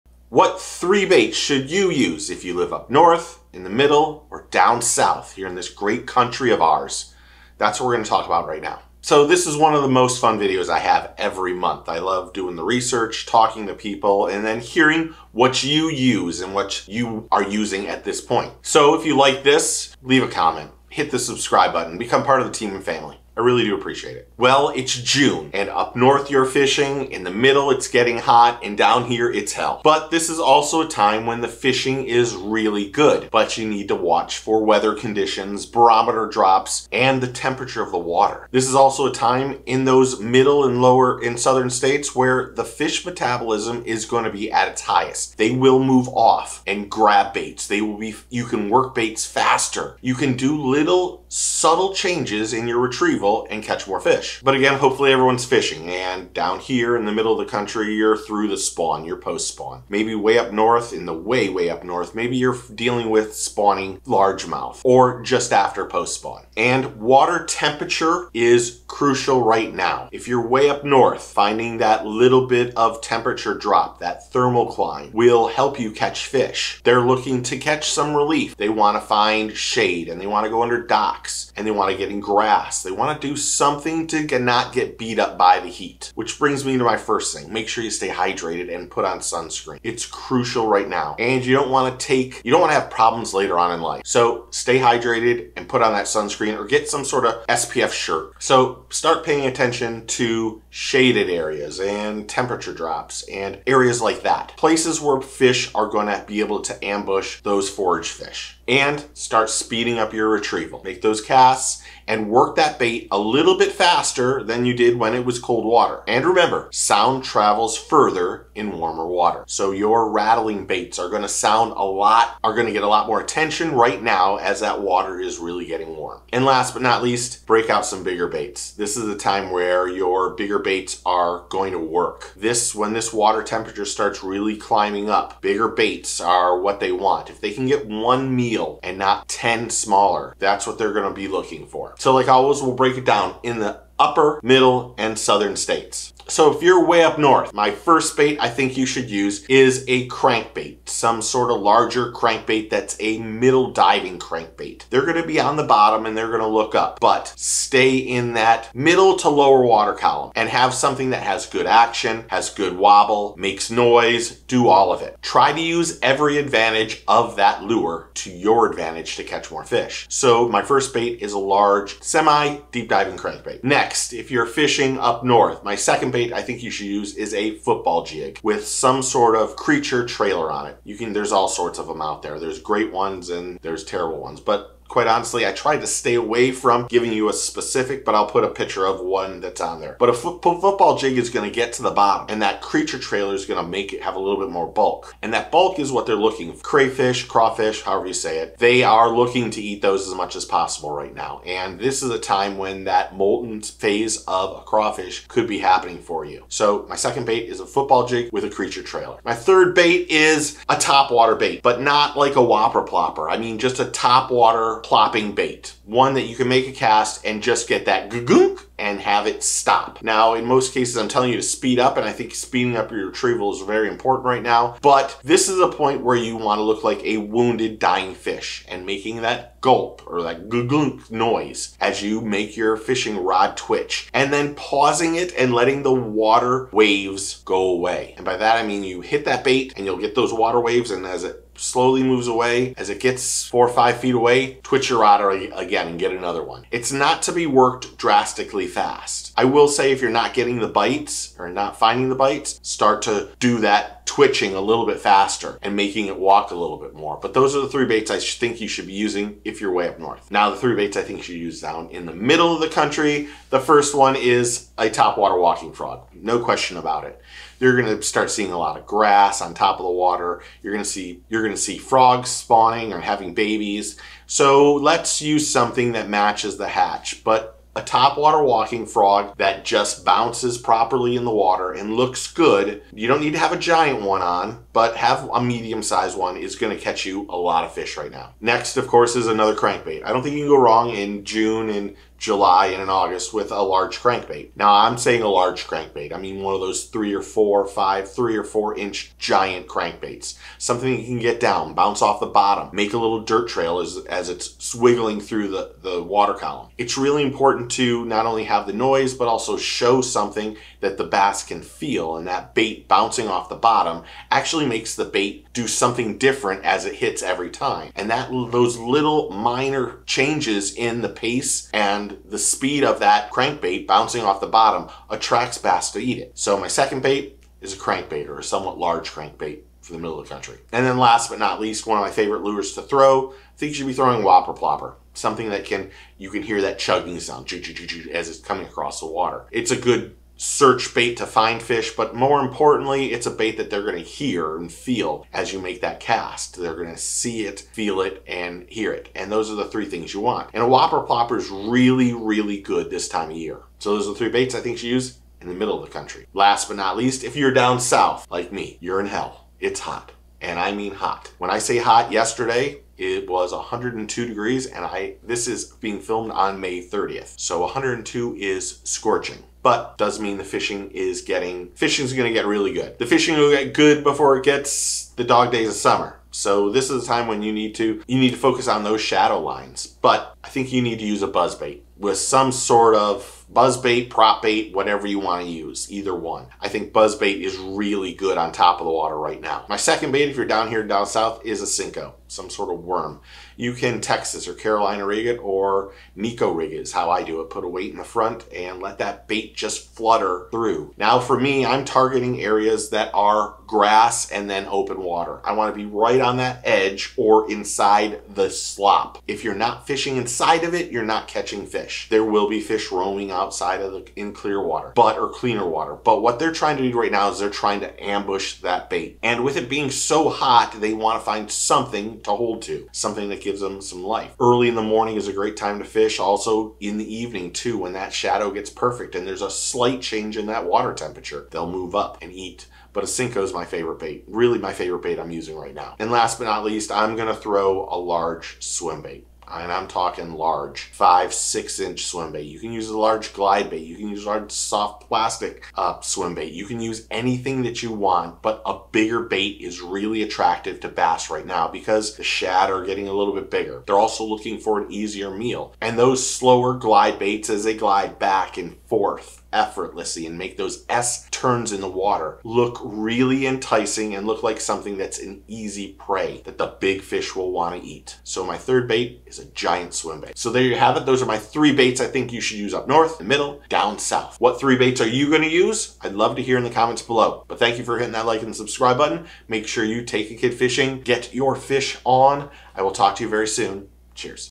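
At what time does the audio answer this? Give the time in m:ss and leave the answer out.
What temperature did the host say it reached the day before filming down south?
6:03.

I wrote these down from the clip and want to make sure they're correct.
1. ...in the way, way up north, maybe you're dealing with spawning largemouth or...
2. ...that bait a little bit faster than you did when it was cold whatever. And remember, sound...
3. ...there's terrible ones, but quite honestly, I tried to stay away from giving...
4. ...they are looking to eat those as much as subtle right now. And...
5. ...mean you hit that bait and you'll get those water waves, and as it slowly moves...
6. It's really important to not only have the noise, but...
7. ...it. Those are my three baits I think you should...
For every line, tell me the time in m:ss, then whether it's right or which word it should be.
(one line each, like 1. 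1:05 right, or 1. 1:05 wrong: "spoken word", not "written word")
1. 1:00 right
2. 1:52 wrong: "water", not "whatever"
3. 3:03 right
4. 3:18 wrong: "possible", not "subtle"
5. 3:58 right
6. 5:06 right
7. 7:50 right.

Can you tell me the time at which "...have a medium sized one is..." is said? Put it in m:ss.
4:44.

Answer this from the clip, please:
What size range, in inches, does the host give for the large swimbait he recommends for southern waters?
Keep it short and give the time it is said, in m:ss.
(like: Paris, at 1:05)
5 to 6 inches, at 7:20.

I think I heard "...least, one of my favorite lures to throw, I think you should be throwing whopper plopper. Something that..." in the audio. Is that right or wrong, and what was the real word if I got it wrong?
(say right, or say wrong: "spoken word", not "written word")
right.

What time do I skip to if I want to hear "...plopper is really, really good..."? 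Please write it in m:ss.
5:51.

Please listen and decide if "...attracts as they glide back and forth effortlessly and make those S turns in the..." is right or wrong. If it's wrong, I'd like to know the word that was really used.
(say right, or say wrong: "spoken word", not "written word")
wrong: "baits", not "attracts".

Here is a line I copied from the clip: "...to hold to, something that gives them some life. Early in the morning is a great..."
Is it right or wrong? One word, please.
right.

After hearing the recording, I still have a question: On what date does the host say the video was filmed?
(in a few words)
May 30th.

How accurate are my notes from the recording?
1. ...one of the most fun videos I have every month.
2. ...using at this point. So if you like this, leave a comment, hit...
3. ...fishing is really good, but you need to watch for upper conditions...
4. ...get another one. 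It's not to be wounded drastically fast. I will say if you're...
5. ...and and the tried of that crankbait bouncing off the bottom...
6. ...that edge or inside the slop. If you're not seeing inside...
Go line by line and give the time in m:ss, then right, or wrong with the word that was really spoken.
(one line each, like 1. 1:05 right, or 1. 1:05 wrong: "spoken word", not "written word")
1. 0:09 right
2. 0:17 right
3. 0:31 wrong: "weather", not "upper"
4. 4:05 wrong: "worked", not "wounded"
5. 5:21 wrong: "speed", not "tried"
6. 6:46 wrong: "fishing", not "seeing".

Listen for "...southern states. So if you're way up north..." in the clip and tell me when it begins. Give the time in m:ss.
2:25.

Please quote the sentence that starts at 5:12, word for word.
And that bait bouncing off the bottom actually makes the bait do something different as it hits every time.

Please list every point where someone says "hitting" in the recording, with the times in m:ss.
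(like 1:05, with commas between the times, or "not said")
7:57.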